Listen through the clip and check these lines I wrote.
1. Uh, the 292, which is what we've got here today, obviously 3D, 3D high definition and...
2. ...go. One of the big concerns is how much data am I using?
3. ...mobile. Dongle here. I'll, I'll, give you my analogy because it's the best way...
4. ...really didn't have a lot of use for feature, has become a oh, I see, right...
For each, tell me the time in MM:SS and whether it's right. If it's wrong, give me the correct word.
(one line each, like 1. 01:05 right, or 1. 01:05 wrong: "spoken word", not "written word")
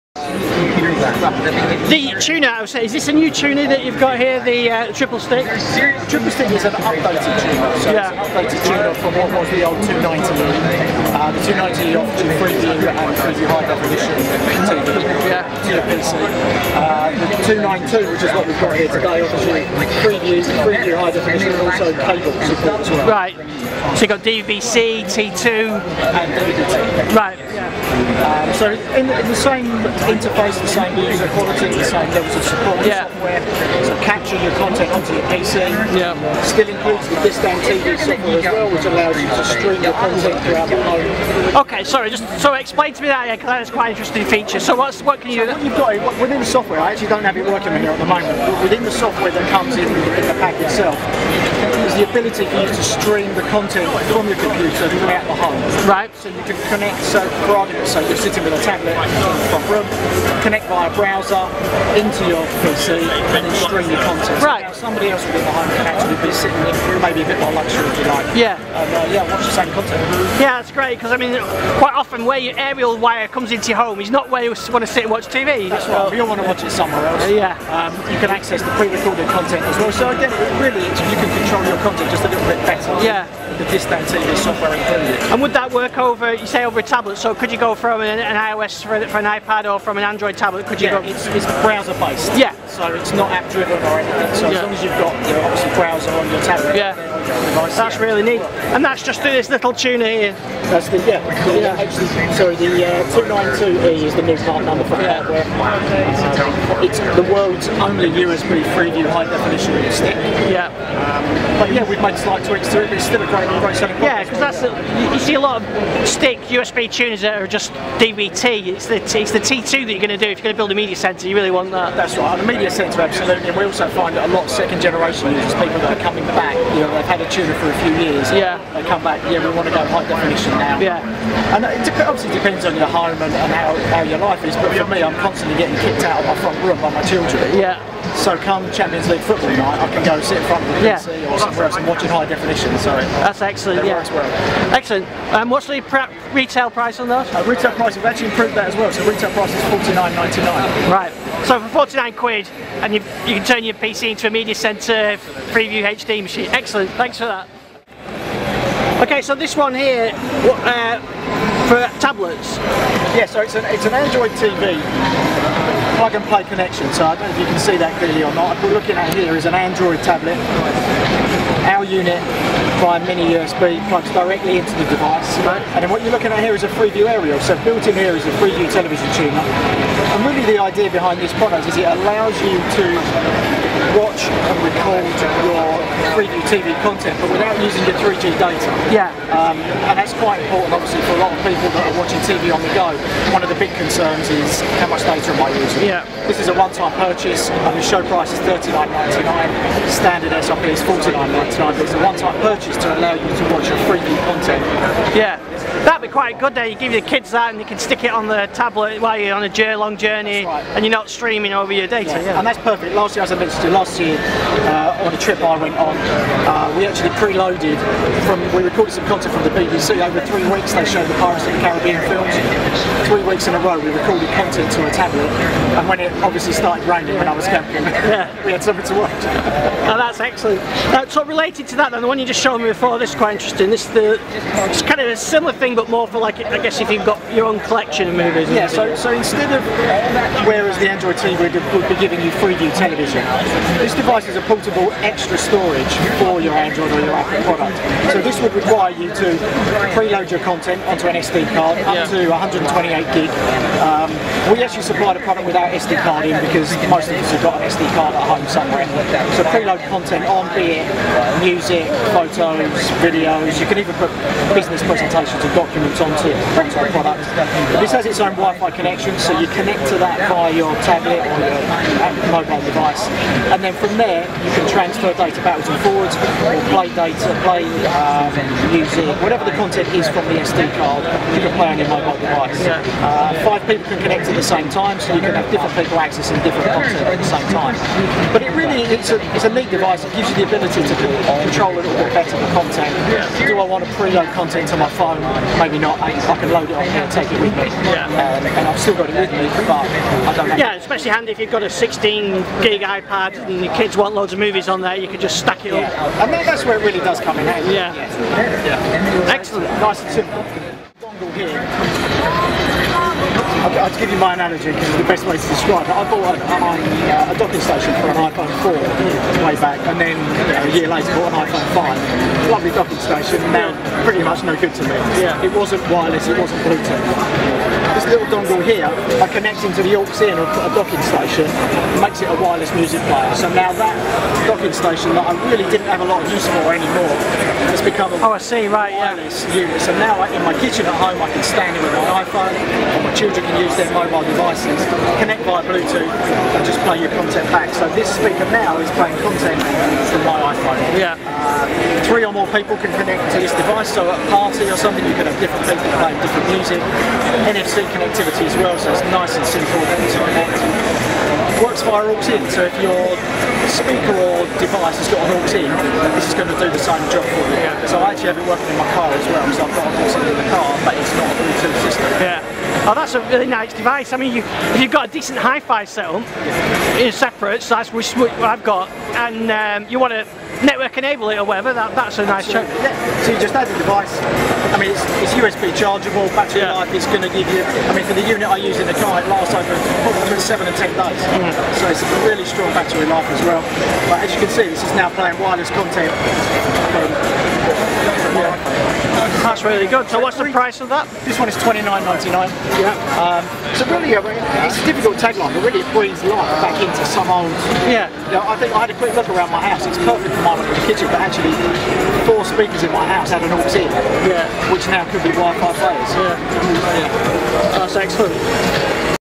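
1. 00:16 right
2. 03:12 right
3. 05:10 wrong: "simple", not "mobile"
4. 05:35 wrong: "anymore", not "feature".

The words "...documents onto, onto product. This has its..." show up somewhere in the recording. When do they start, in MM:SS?
04:25.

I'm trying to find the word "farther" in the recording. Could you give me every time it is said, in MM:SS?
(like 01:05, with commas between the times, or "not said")
not said.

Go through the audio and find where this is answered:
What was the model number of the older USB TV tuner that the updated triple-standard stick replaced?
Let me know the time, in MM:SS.
00:09.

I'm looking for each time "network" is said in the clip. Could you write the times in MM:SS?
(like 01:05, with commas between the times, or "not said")
06:20.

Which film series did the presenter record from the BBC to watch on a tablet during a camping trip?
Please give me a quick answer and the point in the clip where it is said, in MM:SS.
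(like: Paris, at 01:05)
Pirates of the Caribbean, at 03:41.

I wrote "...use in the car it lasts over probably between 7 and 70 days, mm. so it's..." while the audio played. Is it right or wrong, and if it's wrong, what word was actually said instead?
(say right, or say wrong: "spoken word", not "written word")
wrong: "10", not "70".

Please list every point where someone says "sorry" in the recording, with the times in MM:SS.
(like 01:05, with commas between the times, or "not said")
00:41, 01:42.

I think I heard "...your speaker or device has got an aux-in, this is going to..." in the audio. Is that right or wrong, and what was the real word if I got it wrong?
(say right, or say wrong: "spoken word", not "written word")
right.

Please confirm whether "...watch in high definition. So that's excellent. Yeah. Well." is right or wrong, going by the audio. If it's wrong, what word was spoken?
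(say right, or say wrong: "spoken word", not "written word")
right.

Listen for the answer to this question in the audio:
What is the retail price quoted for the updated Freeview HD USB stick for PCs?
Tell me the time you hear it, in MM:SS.
02:29.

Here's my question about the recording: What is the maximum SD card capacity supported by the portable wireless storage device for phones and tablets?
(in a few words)
128 GB.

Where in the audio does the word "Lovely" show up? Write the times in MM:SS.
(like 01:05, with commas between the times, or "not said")
05:22.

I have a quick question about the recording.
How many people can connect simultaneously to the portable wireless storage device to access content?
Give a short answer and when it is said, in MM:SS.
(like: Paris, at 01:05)
5, at 04:43.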